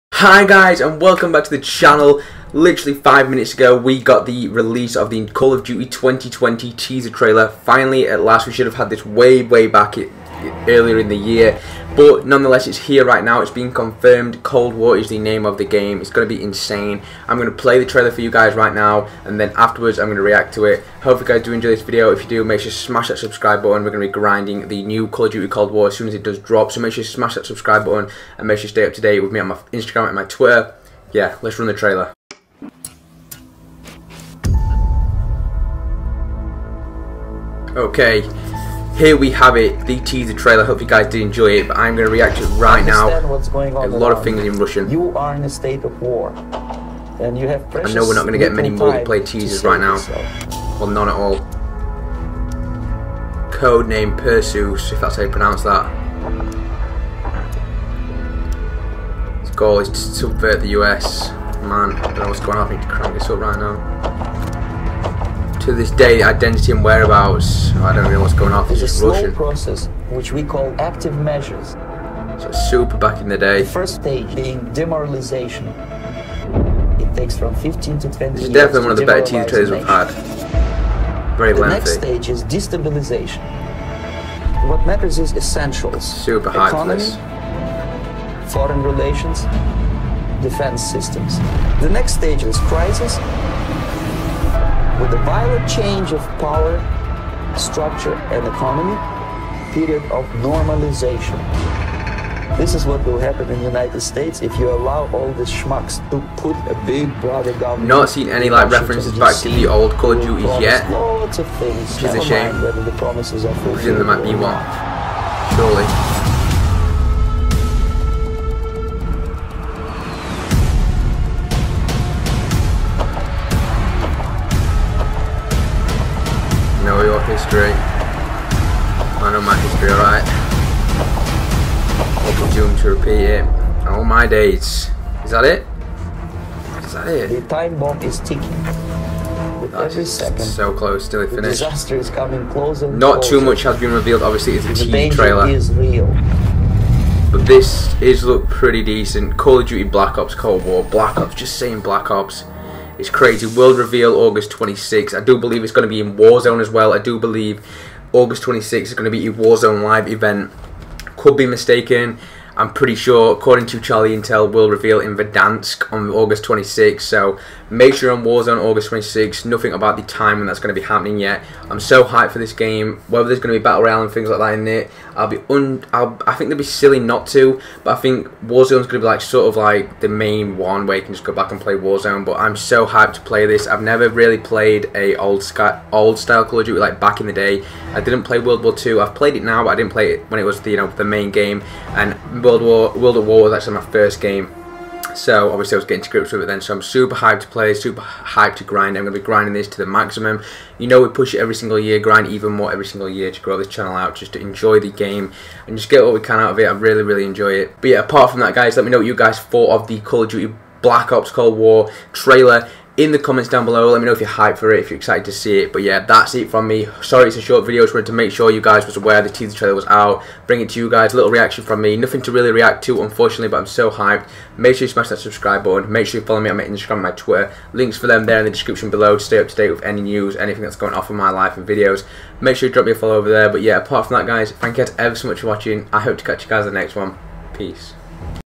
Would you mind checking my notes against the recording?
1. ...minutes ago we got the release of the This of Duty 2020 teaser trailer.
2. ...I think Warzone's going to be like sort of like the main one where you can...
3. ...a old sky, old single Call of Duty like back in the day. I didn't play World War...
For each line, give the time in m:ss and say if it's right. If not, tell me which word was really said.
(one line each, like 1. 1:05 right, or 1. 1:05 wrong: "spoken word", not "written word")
1. 0:03 wrong: "Call", not "This"
2. 2:57 right
3. 3:04 wrong: "style", not "single".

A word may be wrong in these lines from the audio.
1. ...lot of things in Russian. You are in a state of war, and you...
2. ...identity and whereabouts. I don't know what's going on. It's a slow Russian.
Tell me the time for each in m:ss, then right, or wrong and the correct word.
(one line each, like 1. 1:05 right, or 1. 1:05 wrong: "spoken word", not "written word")
1. 0:43 right
2. 1:06 right.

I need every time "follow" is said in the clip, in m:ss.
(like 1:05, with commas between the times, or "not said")
3:46, 3:52.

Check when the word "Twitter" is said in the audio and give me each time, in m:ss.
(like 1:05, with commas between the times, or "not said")
0:30, 3:47.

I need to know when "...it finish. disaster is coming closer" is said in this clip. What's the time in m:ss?
2:21.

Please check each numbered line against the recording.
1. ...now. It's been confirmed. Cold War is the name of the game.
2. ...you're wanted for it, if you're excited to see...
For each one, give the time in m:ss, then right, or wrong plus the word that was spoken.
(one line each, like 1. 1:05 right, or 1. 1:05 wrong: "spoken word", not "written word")
1. 0:13 right
2. 3:34 wrong: "hyped", not "wanted".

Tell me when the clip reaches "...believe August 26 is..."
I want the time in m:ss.
2:37.